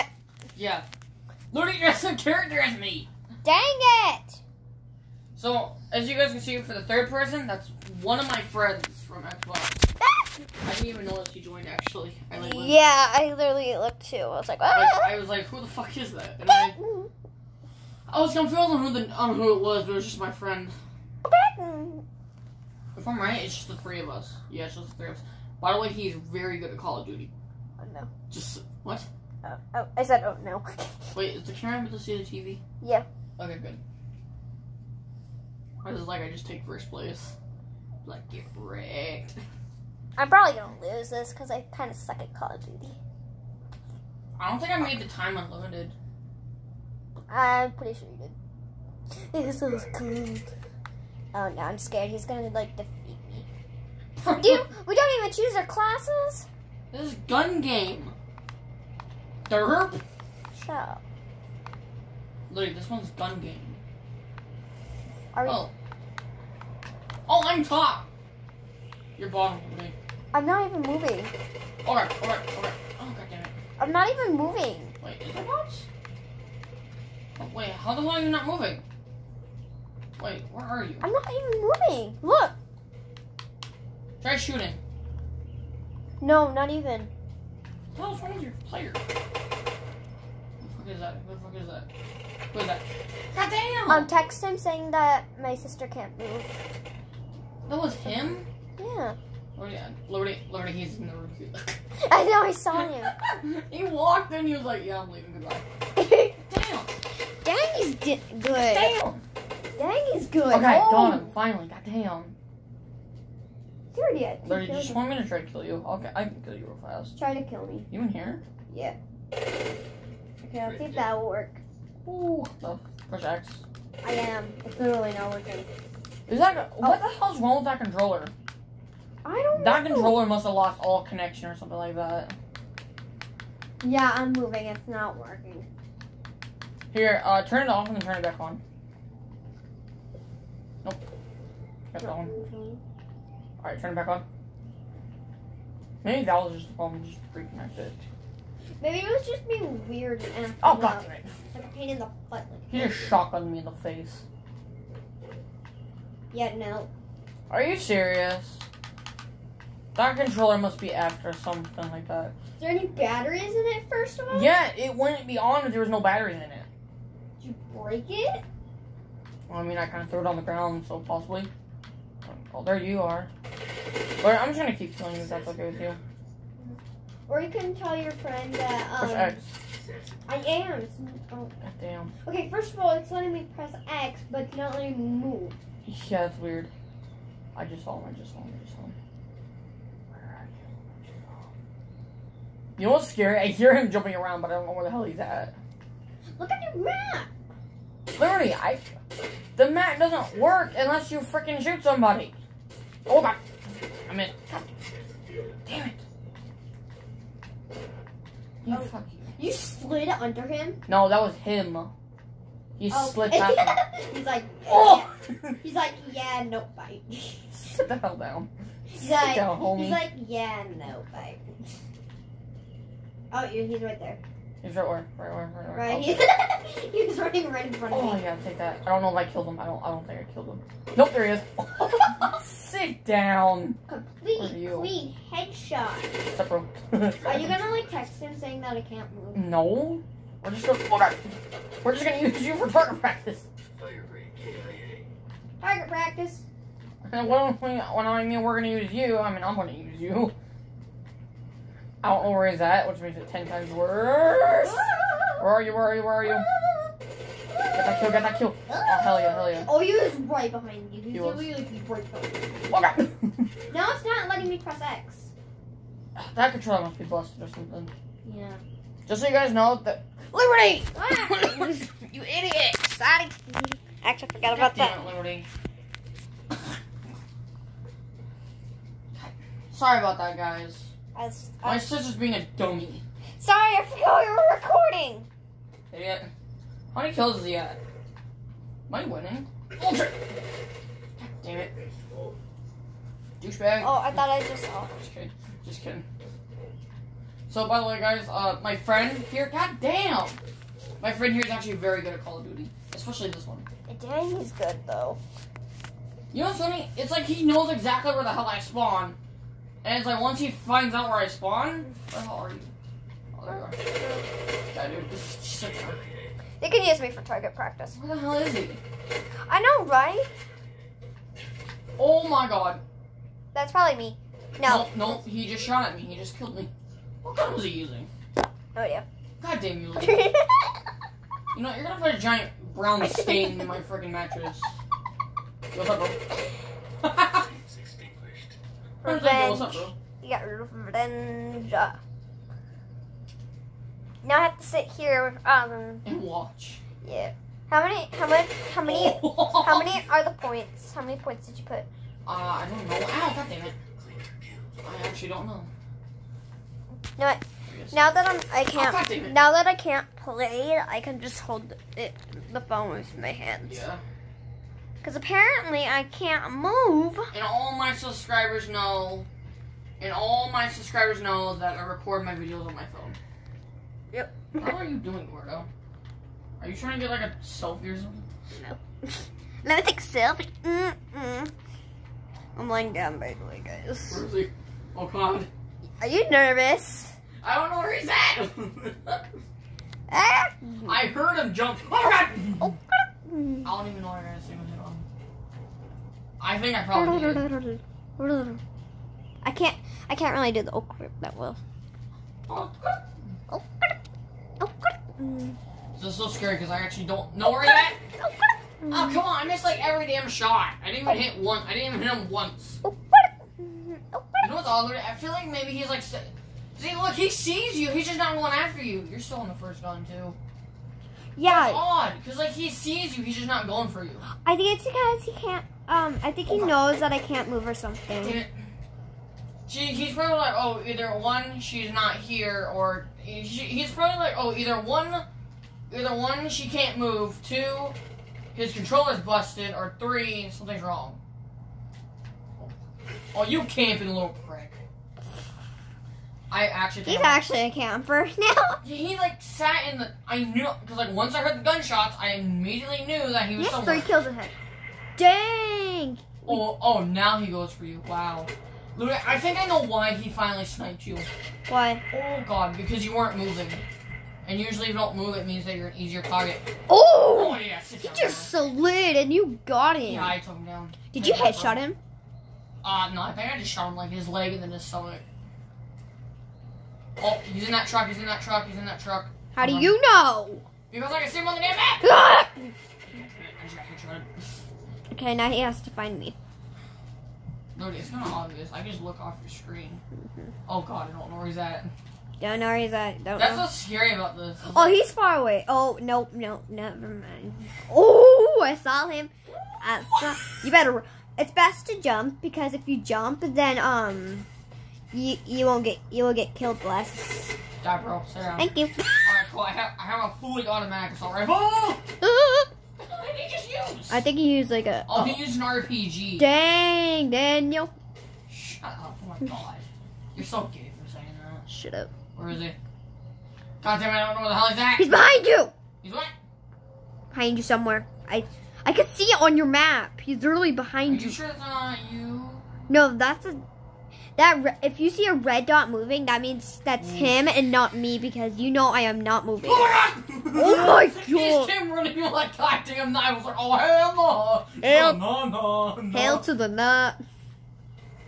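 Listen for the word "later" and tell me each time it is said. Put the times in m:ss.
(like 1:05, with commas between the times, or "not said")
not said.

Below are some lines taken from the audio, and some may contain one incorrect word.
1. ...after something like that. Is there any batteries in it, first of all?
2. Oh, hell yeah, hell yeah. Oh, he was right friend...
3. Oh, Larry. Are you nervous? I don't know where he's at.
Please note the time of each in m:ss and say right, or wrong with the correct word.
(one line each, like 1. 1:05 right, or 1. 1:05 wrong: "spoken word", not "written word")
1. 2:40 right
2. 4:18 wrong: "behind", not "friend"
3. 6:24 wrong: "God", not "Larry".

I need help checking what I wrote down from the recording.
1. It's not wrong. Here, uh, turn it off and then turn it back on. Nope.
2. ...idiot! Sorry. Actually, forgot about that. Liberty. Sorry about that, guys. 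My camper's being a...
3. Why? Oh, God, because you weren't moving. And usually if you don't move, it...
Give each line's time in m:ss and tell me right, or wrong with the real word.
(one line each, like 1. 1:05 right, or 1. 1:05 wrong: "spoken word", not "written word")
1. 2:14 wrong: "working", not "wrong"
2. 4:32 wrong: "sister", not "camper"
3. 7:41 right.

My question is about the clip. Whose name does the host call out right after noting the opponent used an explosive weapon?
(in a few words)
Daniel.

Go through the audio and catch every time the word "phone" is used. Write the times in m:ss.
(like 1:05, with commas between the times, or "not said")
6:02, 6:12.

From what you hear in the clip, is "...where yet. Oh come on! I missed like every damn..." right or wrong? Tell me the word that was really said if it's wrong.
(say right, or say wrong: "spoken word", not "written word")
right.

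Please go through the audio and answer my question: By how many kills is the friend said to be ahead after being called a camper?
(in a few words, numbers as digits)
3.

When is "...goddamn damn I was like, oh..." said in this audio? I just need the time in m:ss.
9:02.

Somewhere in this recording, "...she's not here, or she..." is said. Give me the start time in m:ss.
7:11.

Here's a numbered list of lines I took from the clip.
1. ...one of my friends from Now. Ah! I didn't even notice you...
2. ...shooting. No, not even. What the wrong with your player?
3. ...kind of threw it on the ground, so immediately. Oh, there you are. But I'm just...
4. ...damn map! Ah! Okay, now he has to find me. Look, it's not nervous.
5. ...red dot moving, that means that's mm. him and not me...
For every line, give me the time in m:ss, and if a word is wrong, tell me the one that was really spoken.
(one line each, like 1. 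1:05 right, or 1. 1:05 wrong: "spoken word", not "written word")
1. 0:07 wrong: "Xbox", not "Now"
2. 1:24 right
3. 2:49 wrong: "possibly", not "immediately"
4. 8:01 wrong: "obvious", not "nervous"
5. 8:55 right.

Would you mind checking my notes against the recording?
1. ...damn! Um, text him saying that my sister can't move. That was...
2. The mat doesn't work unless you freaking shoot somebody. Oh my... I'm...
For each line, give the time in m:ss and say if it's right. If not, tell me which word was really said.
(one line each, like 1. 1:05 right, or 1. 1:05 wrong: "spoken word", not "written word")
1. 1:33 right
2. 3:19 right.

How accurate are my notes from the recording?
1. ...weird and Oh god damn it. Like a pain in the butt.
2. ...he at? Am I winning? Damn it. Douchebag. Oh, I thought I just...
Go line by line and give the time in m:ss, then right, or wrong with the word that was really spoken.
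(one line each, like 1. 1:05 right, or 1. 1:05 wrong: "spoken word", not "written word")
1. 2:29 right
2. 4:47 right.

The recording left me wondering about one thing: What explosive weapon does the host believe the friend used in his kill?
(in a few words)
RPG.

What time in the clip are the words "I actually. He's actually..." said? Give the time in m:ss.
7:26.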